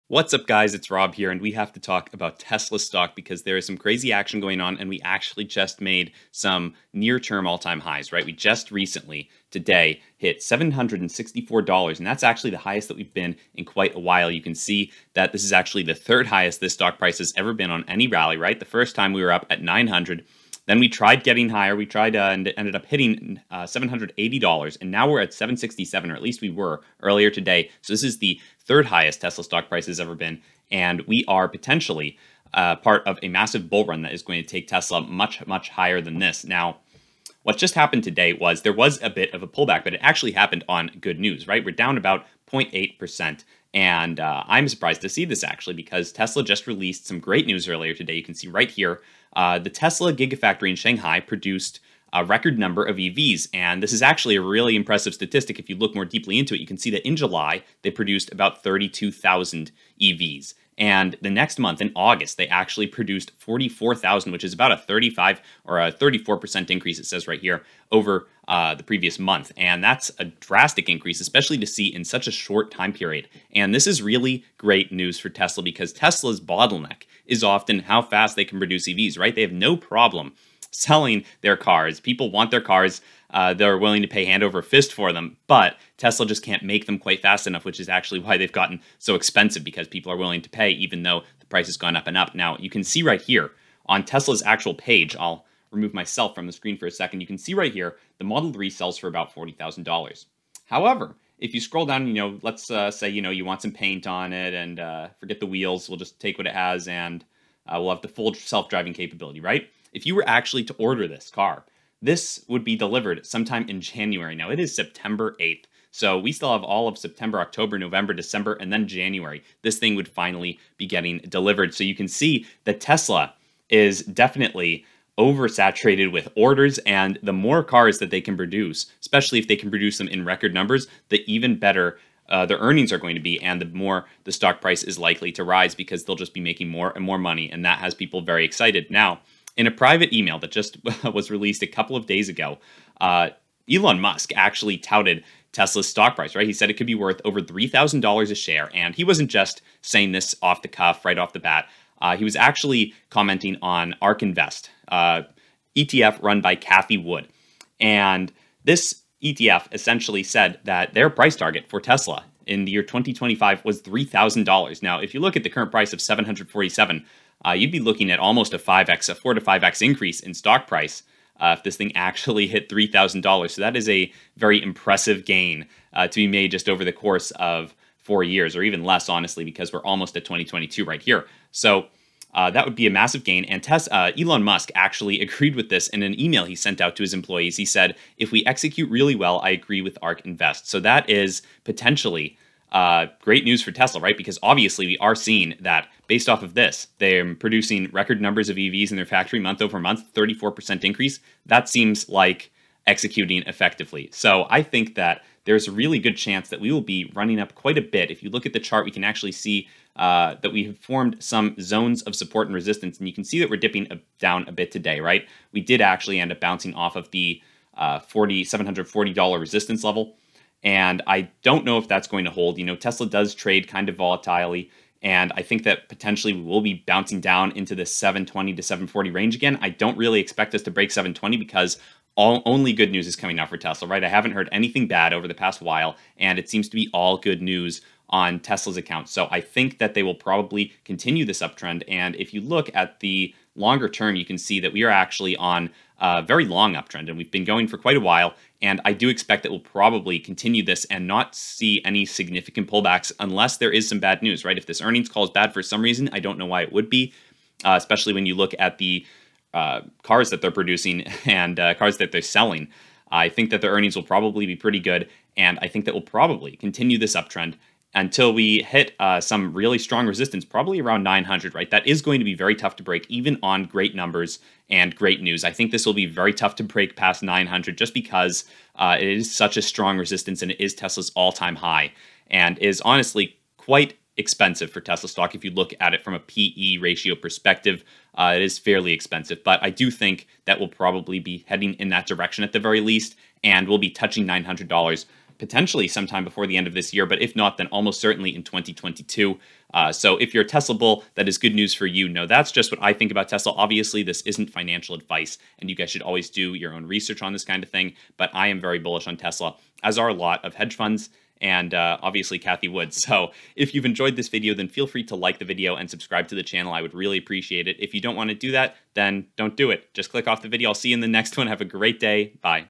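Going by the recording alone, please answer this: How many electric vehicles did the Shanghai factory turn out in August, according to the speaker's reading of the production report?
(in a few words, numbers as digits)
44,000.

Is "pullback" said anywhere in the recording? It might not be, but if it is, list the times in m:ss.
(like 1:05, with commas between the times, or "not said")
0:39, 4:12.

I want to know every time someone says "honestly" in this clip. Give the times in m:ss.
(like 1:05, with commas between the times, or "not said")
2:59, 4:42.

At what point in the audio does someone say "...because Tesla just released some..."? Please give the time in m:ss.
0:45.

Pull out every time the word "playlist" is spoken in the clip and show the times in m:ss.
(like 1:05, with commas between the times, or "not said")
not said.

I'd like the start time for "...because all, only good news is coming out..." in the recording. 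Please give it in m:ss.
3:51.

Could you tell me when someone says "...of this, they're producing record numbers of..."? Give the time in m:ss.
3:16.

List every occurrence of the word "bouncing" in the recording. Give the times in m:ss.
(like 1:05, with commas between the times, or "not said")
3:36, 3:46.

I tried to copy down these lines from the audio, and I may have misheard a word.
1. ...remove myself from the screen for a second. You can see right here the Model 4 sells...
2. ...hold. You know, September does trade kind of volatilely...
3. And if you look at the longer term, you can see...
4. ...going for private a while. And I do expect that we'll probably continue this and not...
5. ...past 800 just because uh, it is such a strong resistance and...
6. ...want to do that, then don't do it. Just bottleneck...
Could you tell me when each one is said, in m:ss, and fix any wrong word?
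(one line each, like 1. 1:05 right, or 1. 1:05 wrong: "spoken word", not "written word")
1. 1:35 wrong: "3", not "4"
2. 3:42 wrong: "Tesla", not "September"
3. 4:01 right
4. 4:07 wrong: "quite", not "private"
5. 4:36 wrong: "900", not "800"
6. 5:18 wrong: "click", not "bottleneck".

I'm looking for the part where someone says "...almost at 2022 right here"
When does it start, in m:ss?
2:59.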